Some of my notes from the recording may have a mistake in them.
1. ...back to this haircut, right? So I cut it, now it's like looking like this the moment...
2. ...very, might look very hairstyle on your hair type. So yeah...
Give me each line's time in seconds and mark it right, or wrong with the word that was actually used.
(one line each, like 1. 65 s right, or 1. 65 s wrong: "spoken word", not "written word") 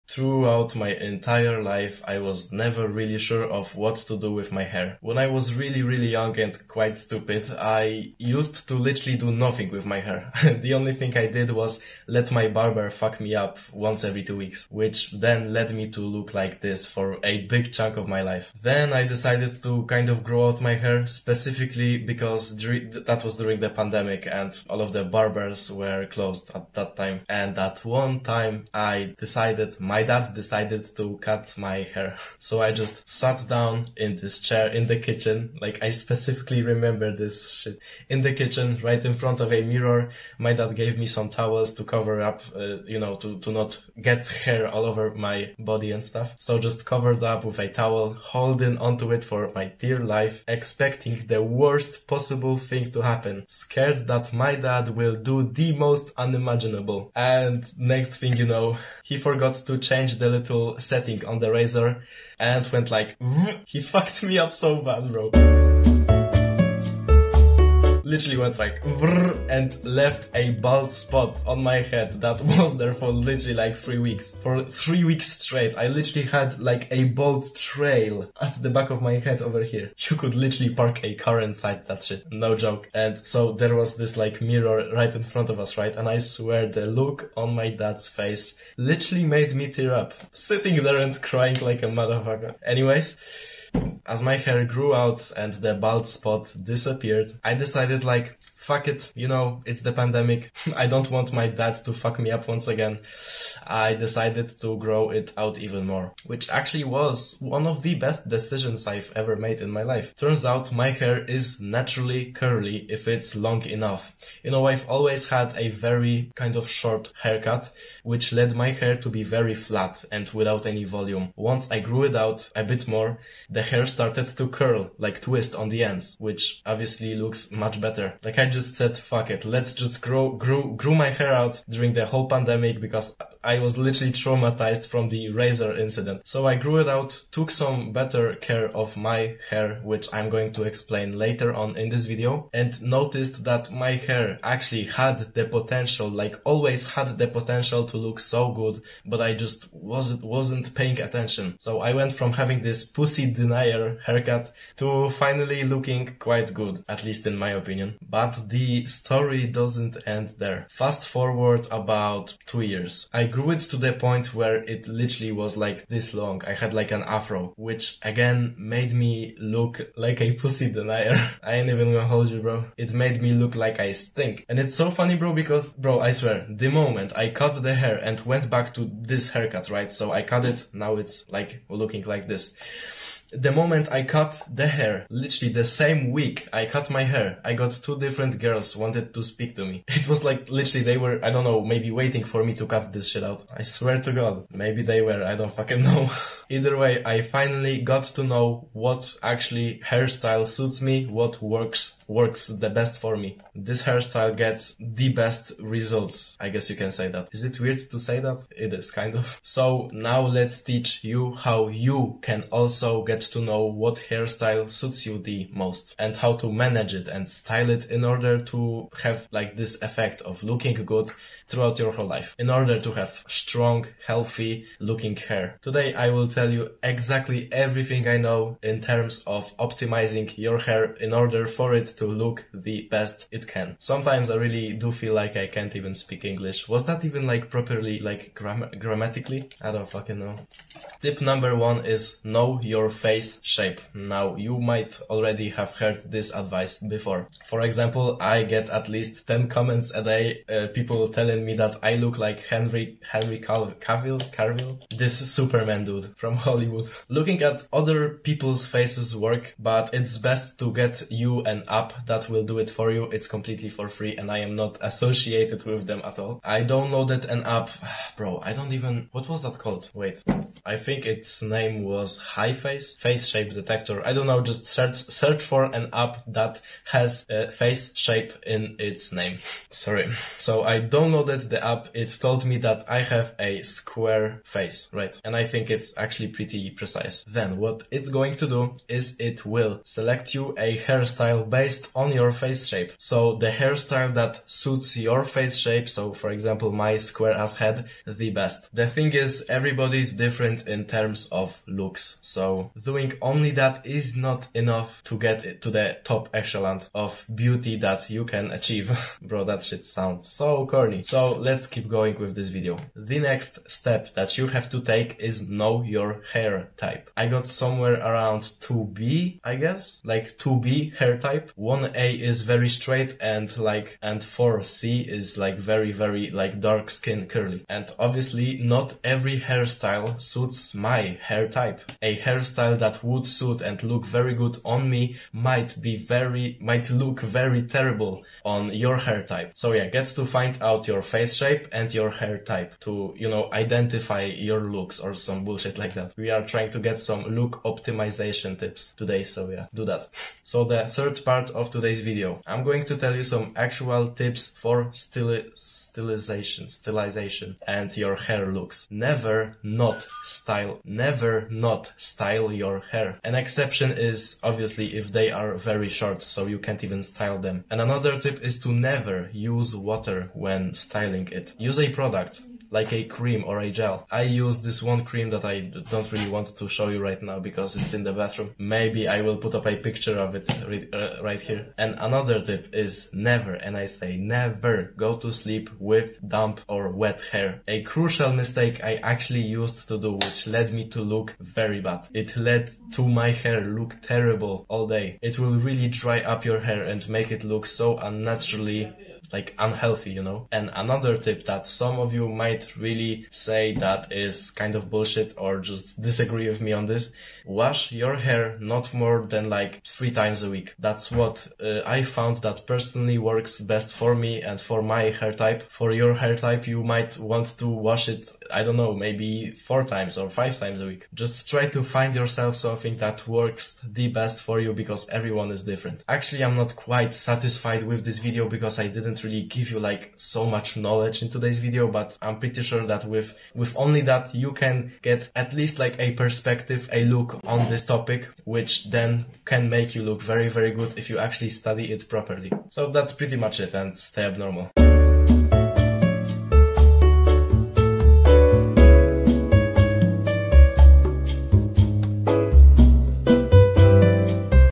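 1. 178 s right
2. 335 s wrong: "terrible", not "hairstyle".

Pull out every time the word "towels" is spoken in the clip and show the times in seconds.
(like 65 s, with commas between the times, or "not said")
41 s, 47 s.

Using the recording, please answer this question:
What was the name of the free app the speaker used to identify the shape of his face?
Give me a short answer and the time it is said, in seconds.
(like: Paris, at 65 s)
HiFace Face Shape Detector, at 272 s.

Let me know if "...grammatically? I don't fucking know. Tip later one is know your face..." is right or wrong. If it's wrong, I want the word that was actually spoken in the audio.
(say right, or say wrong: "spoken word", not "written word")
wrong: "number", not "later".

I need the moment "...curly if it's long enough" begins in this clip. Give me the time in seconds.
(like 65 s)
112 s.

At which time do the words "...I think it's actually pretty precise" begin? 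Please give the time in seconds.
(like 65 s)
285 s.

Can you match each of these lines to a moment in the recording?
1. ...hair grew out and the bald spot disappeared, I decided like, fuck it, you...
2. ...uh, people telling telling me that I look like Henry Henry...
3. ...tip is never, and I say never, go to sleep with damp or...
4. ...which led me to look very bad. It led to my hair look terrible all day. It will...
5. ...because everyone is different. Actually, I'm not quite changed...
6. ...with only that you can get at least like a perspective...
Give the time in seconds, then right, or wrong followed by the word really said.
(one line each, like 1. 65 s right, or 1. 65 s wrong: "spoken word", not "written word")
1. 94 s right
2. 250 s right
3. 382 s right
4. 390 s right
5. 424 s wrong: "satisfied", not "changed"
6. 433 s right.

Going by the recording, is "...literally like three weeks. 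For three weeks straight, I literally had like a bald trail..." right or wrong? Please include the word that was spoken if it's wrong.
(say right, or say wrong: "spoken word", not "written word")
right.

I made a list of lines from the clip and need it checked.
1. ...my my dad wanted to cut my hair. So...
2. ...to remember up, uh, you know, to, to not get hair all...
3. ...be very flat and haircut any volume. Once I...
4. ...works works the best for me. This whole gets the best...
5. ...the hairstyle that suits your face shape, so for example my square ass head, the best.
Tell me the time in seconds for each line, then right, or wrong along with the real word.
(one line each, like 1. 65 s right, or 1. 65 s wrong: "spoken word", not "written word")
1. 29 s wrong: "decided", not "wanted"
2. 41 s wrong: "cover", not "remember"
3. 119 s wrong: "without", not "haircut"
4. 201 s wrong: "hairstyle", not "whole"
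5. 293 s right.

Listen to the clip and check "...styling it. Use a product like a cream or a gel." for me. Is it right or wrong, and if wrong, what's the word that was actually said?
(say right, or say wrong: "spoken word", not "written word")
right.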